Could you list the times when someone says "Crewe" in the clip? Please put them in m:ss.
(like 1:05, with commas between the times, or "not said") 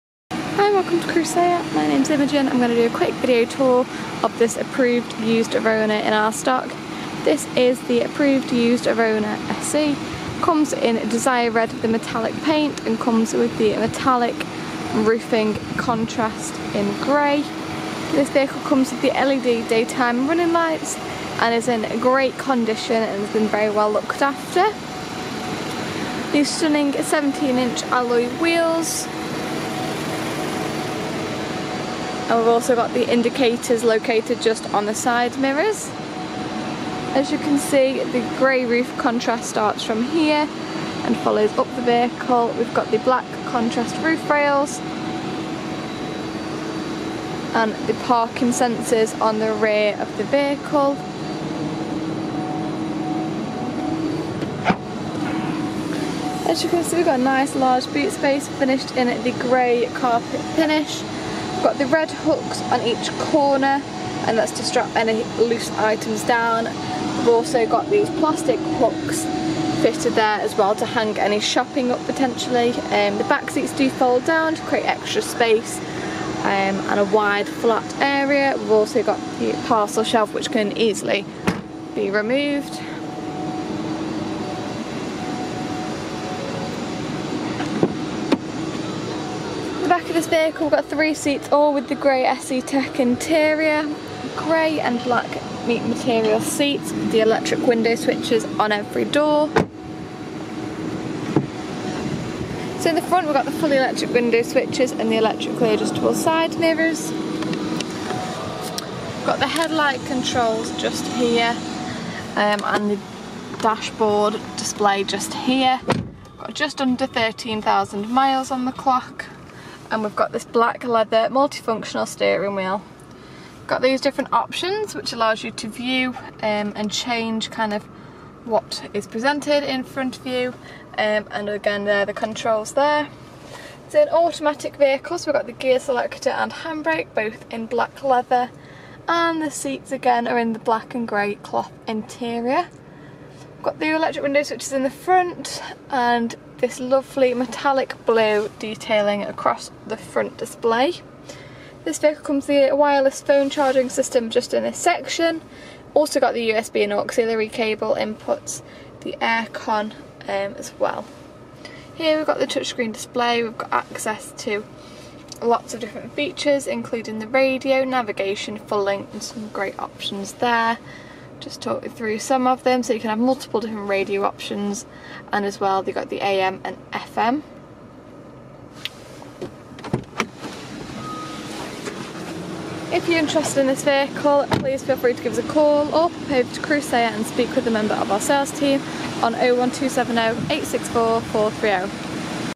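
0:01, 3:06.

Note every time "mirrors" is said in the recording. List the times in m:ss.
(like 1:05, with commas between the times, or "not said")
0:35, 1:46.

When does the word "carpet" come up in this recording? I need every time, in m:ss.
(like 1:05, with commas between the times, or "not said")
0:59.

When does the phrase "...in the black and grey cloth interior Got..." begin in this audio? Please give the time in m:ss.
2:20.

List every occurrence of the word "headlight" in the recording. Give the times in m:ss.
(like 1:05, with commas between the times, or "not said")
1:49.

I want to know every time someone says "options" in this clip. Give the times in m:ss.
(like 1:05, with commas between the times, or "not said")
2:04, 2:49, 2:54.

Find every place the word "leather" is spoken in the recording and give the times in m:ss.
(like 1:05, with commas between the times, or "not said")
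2:00, 2:18.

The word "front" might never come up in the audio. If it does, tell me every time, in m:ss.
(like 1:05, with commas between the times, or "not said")
1:43, 2:09, 2:24, 2:29.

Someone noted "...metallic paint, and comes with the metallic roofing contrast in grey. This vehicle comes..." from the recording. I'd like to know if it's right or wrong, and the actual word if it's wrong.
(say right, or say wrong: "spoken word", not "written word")
right.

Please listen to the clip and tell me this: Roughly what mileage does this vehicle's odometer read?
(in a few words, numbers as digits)
Just under 13,000.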